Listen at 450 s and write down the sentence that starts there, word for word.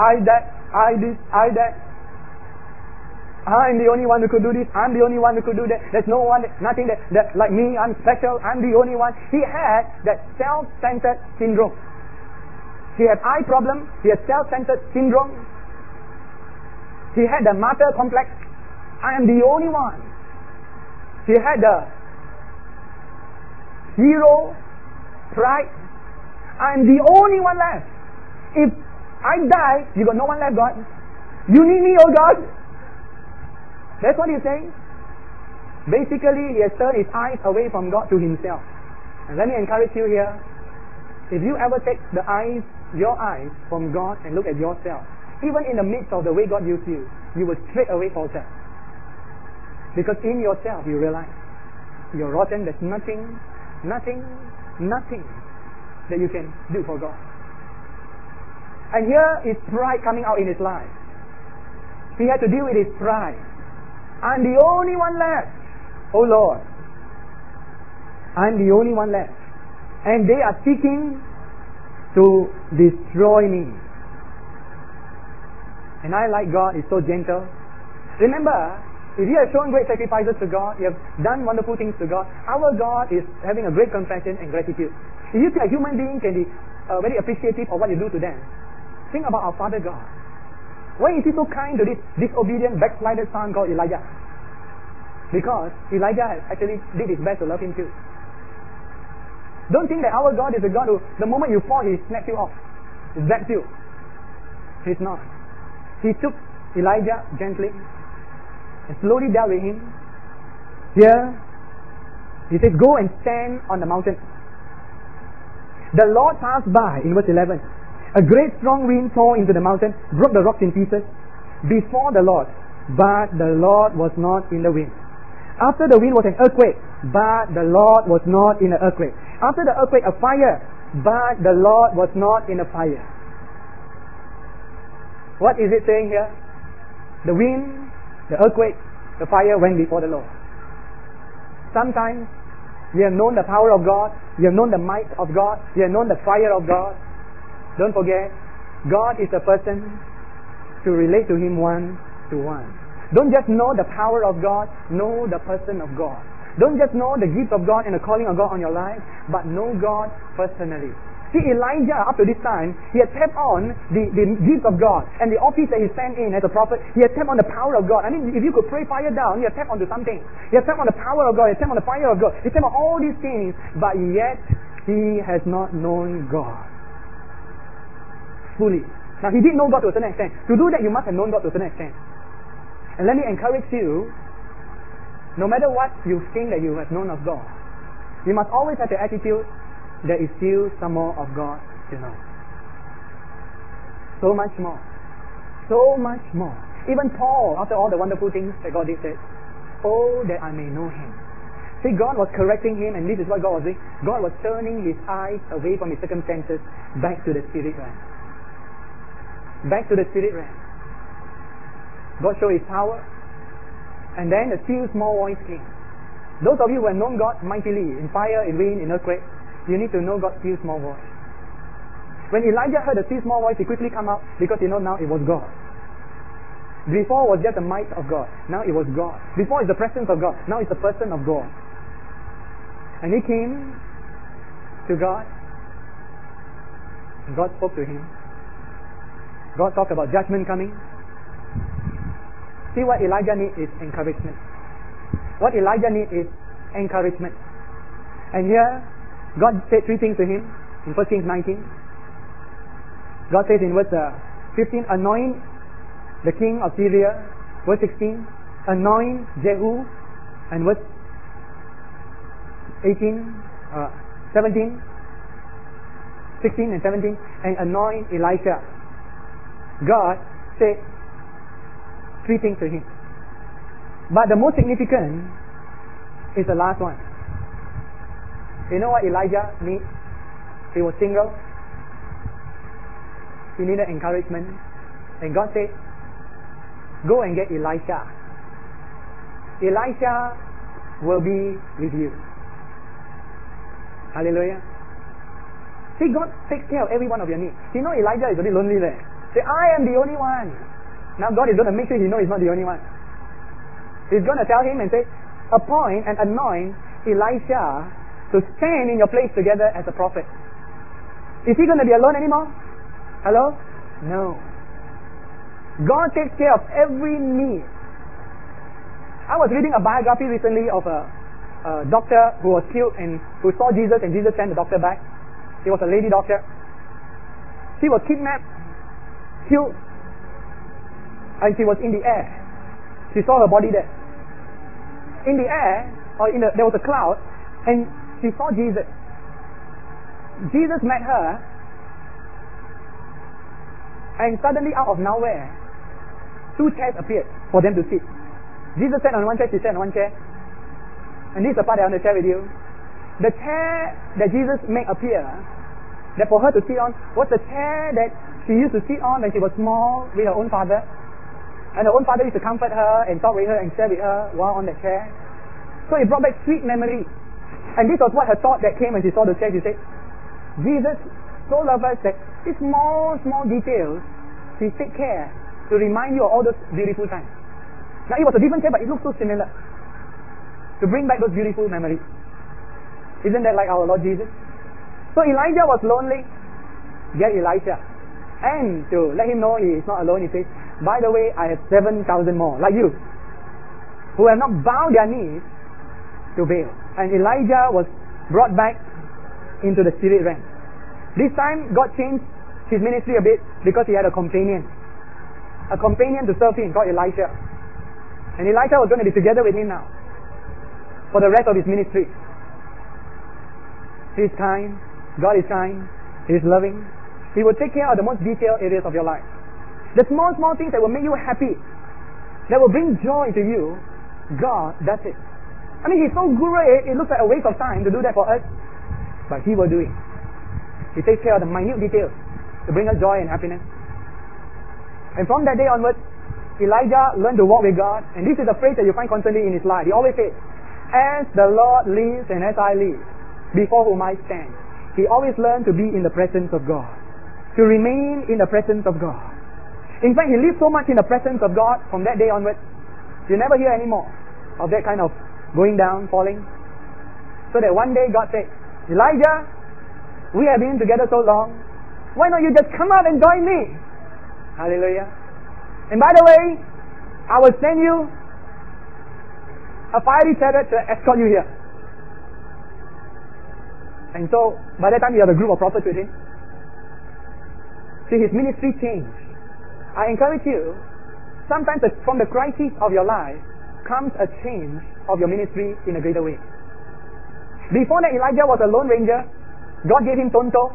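In fact, he lived so much in the presence of God from that day onward.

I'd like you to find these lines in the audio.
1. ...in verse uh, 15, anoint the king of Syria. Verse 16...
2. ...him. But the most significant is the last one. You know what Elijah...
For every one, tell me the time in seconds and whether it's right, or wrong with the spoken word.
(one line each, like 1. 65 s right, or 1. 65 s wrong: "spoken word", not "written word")
1. 253 s right
2. 272 s right.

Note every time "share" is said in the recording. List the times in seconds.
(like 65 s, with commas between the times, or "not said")
352 s, 363 s.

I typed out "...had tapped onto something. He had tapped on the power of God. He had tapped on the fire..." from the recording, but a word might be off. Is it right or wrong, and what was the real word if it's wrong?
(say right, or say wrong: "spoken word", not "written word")
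right.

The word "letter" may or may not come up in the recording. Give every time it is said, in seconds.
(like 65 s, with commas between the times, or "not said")
not said.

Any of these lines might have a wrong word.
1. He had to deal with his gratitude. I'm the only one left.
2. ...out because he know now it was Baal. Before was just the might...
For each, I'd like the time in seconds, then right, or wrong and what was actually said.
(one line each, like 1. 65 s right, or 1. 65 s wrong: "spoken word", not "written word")
1. 62 s wrong: "pride", not "gratitude"
2. 224 s wrong: "God", not "Baal".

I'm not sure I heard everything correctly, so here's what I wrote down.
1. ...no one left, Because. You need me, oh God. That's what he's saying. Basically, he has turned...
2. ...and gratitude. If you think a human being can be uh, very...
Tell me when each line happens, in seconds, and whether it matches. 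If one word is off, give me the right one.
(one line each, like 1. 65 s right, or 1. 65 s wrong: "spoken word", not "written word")
1. 30 s wrong: "God", not "Because"
2. 84 s right.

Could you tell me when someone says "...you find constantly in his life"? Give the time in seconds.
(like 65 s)
438 s.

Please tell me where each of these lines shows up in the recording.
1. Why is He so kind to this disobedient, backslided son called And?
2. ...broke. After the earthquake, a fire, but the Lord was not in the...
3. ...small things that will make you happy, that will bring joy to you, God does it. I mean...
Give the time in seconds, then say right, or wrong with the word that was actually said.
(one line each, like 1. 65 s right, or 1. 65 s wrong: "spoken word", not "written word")
1. 90 s wrong: "Elijah", not "And"
2. 128 s wrong: "earthquake", not "broke"
3. 420 s right.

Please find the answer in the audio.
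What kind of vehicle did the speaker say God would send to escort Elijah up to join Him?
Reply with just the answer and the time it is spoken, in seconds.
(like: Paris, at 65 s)
Fiery chariot, at 470 s.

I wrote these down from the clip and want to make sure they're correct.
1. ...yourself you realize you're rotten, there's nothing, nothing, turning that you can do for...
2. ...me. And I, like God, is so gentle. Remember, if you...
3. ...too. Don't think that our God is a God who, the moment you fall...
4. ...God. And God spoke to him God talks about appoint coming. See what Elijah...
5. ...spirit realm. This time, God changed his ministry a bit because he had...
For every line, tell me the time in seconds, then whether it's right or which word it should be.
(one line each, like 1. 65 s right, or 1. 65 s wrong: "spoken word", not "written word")
1. 50 s wrong: "nothing", not "turning"
2. 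73 s right
3. 97 s right
4. 234 s wrong: "judgment", not "appoint"
5. 400 s right.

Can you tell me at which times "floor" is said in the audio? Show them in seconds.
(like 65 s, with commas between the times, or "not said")
not said.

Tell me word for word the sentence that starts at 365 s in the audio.
So it brought back sweet memories.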